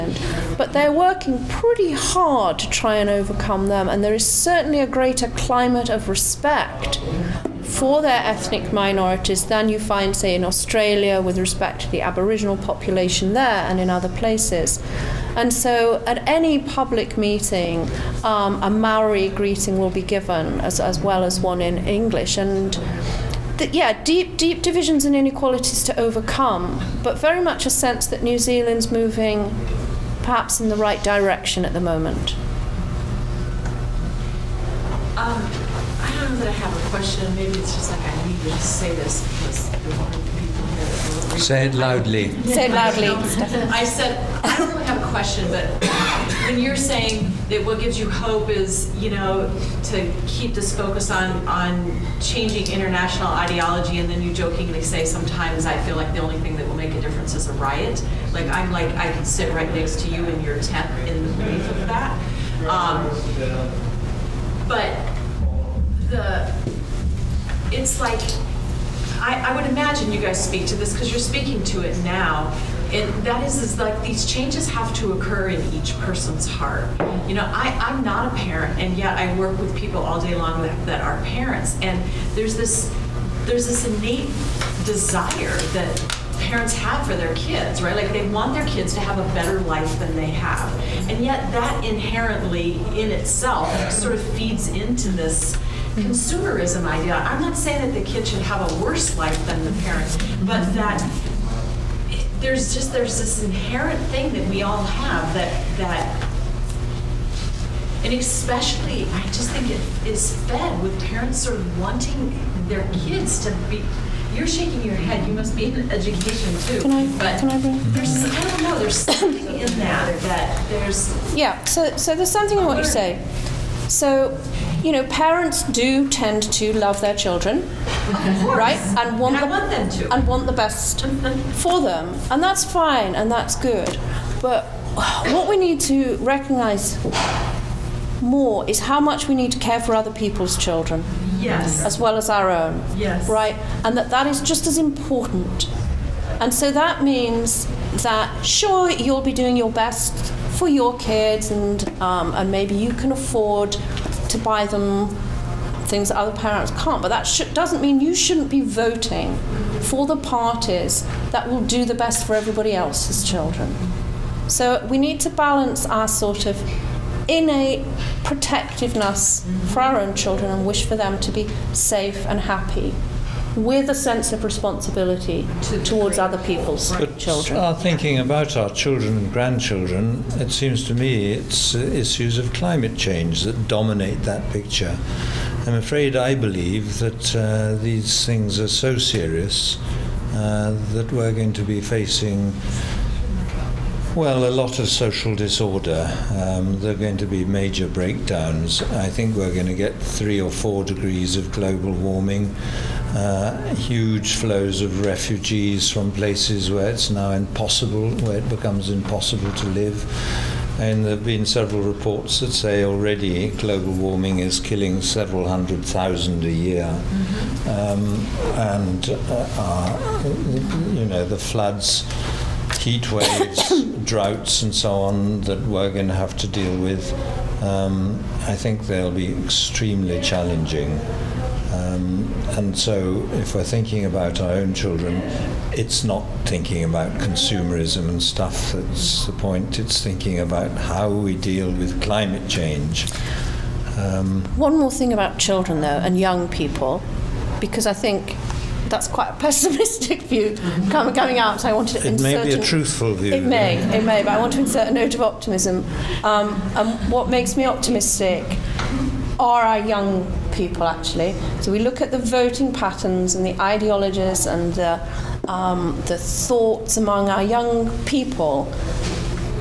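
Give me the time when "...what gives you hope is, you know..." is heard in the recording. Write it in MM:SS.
00:47.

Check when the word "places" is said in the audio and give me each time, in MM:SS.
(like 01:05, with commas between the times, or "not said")
00:14, 03:26.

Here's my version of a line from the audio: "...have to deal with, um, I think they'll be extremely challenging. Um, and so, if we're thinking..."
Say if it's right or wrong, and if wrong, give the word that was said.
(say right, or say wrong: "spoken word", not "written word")
right.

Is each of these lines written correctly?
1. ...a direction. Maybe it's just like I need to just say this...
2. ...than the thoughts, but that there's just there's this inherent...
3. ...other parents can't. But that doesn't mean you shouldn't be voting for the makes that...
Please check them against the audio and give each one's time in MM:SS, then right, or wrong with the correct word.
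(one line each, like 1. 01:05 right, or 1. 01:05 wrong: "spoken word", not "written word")
1. 00:36 wrong: "question", not "direction"
2. 01:39 wrong: "parents", not "thoughts"
3. 02:36 wrong: "parties", not "makes".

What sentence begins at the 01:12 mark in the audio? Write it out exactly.
And that is, is like these changes have to occur in each person's heart.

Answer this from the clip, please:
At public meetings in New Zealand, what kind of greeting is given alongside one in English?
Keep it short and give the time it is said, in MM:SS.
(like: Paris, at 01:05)
Maori greeting, at 00:18.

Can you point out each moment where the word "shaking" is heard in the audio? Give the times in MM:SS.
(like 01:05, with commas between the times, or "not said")
01:54.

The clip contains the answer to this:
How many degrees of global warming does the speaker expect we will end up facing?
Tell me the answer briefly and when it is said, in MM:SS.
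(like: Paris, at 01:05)
3 or 4 degrees, at 03:19.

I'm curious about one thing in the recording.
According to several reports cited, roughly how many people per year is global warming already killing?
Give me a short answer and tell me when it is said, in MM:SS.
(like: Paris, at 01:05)
several hundred thousand, at 03:34.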